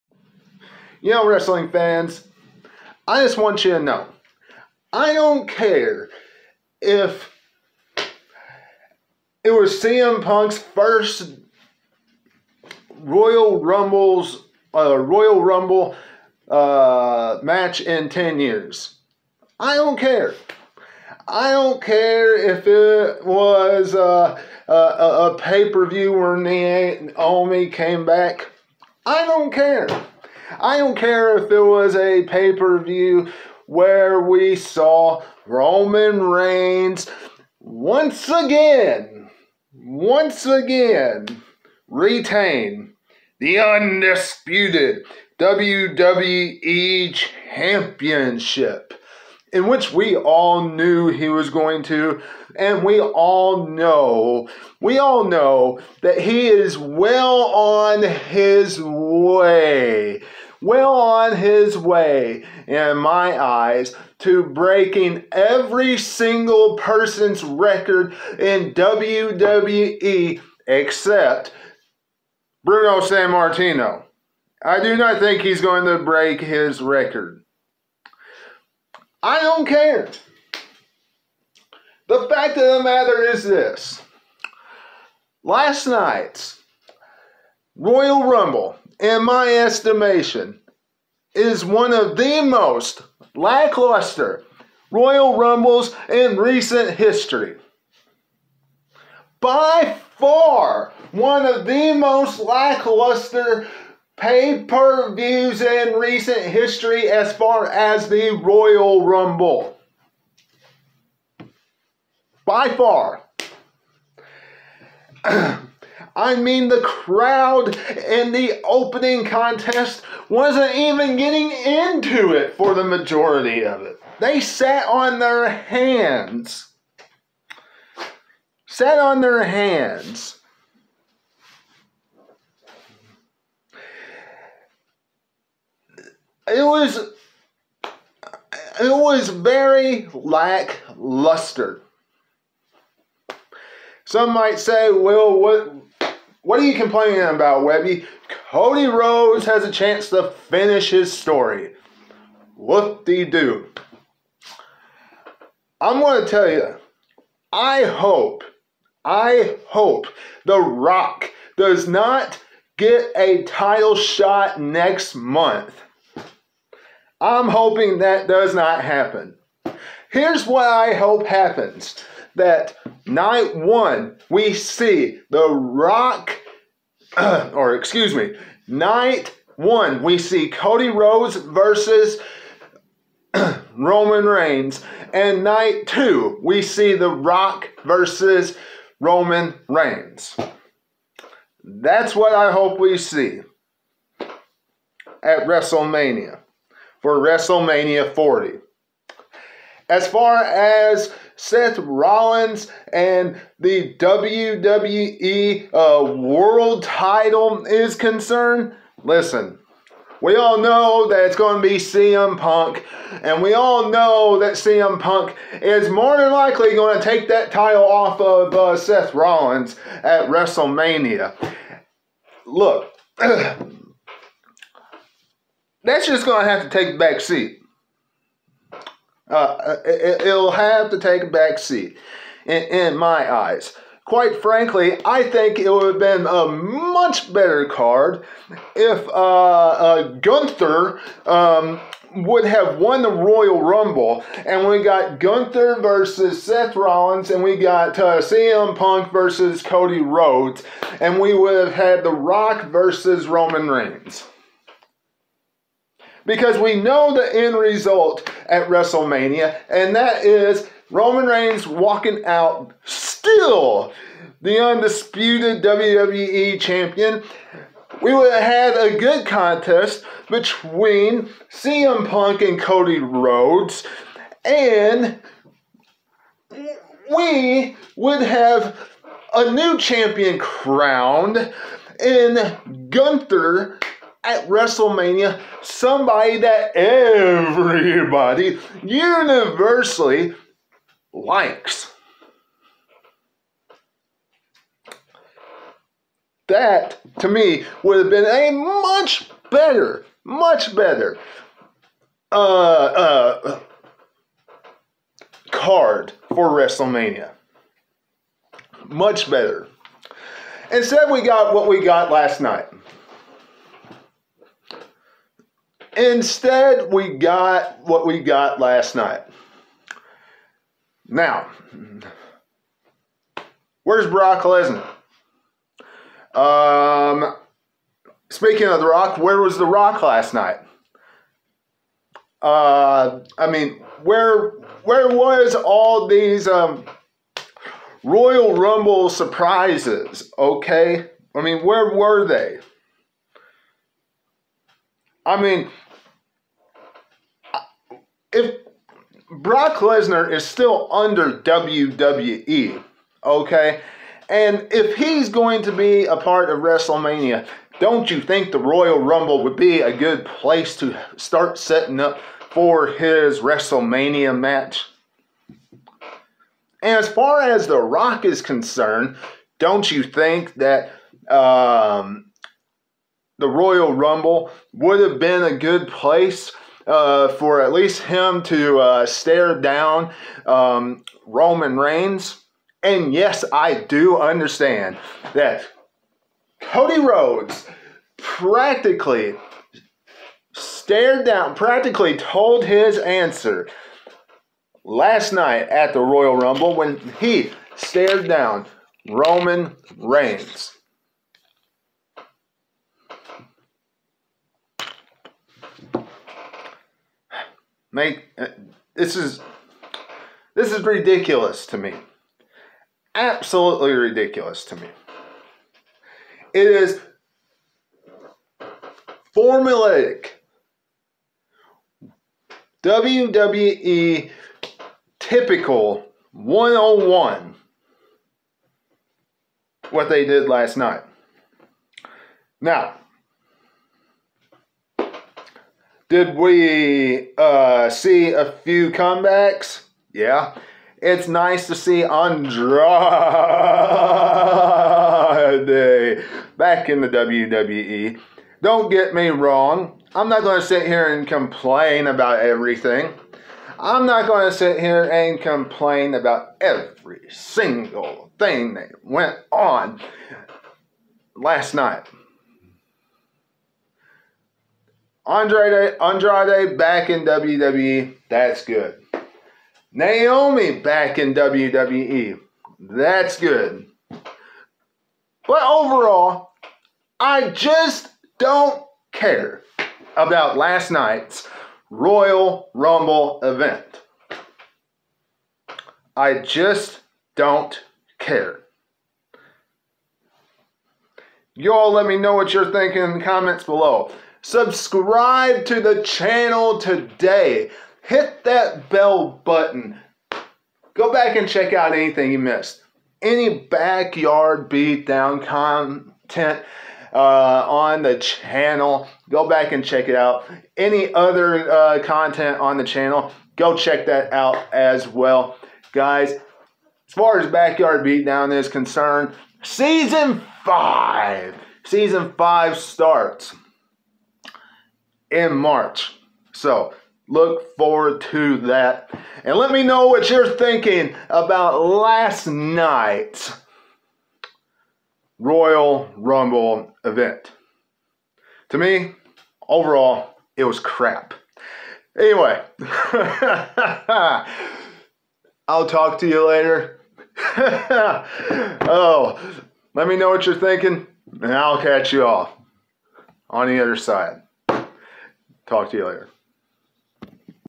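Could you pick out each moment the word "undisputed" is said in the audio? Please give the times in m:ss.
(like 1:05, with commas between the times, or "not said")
0:43, 4:24.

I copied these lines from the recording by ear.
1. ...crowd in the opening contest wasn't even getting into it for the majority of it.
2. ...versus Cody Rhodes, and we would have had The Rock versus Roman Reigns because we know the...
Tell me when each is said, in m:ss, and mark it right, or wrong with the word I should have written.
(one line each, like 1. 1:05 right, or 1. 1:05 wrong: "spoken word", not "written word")
1. 1:56 right
2. 4:09 right.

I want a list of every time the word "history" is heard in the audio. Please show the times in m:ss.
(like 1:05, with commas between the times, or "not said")
1:36, 1:46.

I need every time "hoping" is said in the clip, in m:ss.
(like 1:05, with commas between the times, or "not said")
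2:47.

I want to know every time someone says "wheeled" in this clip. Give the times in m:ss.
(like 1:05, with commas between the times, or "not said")
not said.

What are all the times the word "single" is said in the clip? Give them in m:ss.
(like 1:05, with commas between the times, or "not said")
1:05, 7:37.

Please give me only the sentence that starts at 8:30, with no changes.
Any other uh, content on the channel, go check that out as well.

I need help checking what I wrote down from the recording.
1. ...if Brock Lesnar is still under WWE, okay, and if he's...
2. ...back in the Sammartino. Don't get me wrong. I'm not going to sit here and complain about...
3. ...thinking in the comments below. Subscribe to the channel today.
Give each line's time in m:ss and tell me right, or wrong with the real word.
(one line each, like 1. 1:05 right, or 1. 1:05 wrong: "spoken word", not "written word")
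1. 5:48 right
2. 7:26 wrong: "WWE", not "Sammartino"
3. 8:12 right.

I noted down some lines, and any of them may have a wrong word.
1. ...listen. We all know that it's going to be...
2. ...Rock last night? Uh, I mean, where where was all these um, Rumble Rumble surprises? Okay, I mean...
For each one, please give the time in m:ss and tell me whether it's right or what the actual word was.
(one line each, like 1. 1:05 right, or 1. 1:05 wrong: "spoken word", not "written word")
1. 3:29 right
2. 5:29 wrong: "Royal", not "Rumble".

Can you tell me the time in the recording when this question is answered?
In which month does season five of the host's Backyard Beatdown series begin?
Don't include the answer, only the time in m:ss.
8:45.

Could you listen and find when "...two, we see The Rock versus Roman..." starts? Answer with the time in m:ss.
3:05.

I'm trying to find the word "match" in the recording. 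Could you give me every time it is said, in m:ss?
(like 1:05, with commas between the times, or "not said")
0:17, 6:04.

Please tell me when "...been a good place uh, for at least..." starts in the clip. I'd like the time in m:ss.
6:15.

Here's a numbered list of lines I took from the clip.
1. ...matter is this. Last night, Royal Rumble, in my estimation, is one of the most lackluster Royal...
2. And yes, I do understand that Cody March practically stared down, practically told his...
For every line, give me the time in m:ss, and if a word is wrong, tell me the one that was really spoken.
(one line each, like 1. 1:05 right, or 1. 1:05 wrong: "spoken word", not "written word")
1. 1:22 right
2. 6:22 wrong: "Rhodes", not "March".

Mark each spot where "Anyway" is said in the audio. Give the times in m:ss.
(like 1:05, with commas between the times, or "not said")
9:02.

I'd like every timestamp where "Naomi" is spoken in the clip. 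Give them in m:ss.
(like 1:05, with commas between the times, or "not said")
0:26, 7:49.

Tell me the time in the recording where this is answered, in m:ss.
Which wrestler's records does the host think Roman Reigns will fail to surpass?
1:12.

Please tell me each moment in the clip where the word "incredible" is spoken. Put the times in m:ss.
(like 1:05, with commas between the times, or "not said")
not said.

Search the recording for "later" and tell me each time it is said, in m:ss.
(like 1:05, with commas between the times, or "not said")
9:06, 9:16.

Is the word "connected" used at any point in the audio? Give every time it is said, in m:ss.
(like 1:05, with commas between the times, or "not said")
not said.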